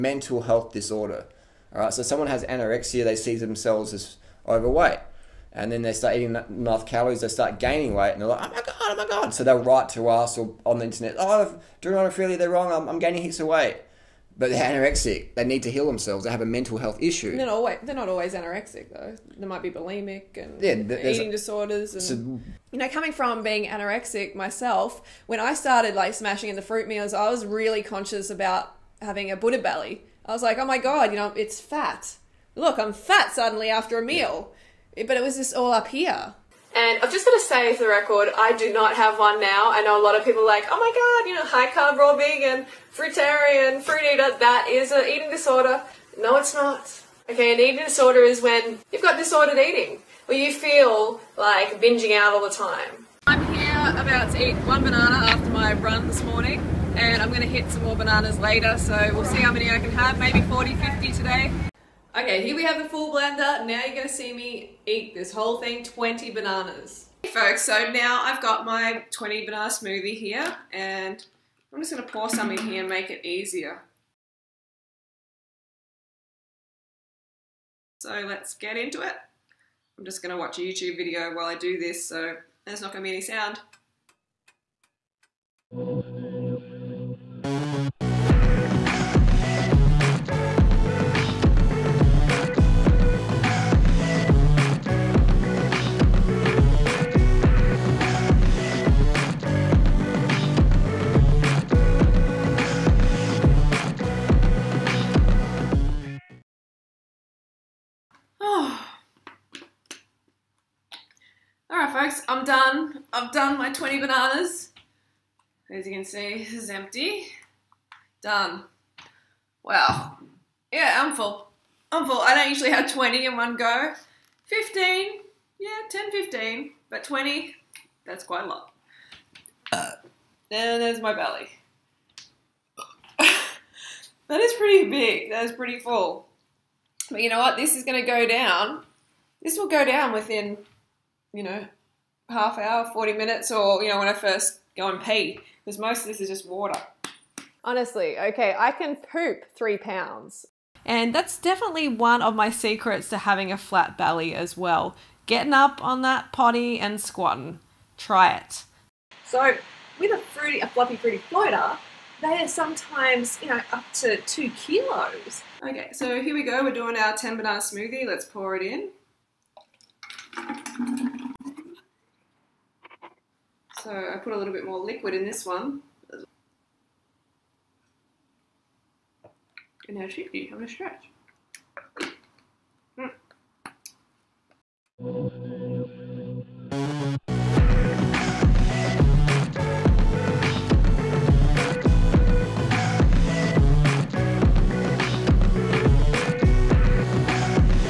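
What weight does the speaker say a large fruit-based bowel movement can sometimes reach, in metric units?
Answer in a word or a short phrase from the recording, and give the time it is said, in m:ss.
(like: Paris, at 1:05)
2 kilos, at 2:44.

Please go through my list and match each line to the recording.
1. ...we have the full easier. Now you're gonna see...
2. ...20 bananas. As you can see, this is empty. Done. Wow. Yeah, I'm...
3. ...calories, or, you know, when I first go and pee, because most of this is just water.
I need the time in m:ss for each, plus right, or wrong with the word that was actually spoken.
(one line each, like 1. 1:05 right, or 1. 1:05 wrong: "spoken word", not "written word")
1. 1:02 wrong: "blender", not "easier"
2. 1:53 right
3. 2:23 wrong: "minutes", not "calories".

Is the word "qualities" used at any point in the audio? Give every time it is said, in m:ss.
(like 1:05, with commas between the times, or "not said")
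not said.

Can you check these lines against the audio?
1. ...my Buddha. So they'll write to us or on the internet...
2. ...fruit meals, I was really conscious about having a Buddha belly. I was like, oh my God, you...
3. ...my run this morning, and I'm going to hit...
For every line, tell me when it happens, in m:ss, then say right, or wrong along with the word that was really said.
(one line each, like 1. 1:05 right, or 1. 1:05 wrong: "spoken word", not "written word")
1. 0:08 wrong: "God", not "Buddha"
2. 0:26 right
3. 0:55 right.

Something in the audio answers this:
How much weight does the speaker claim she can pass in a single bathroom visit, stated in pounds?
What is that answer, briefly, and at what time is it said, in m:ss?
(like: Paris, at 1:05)
3 pounds, at 2:29.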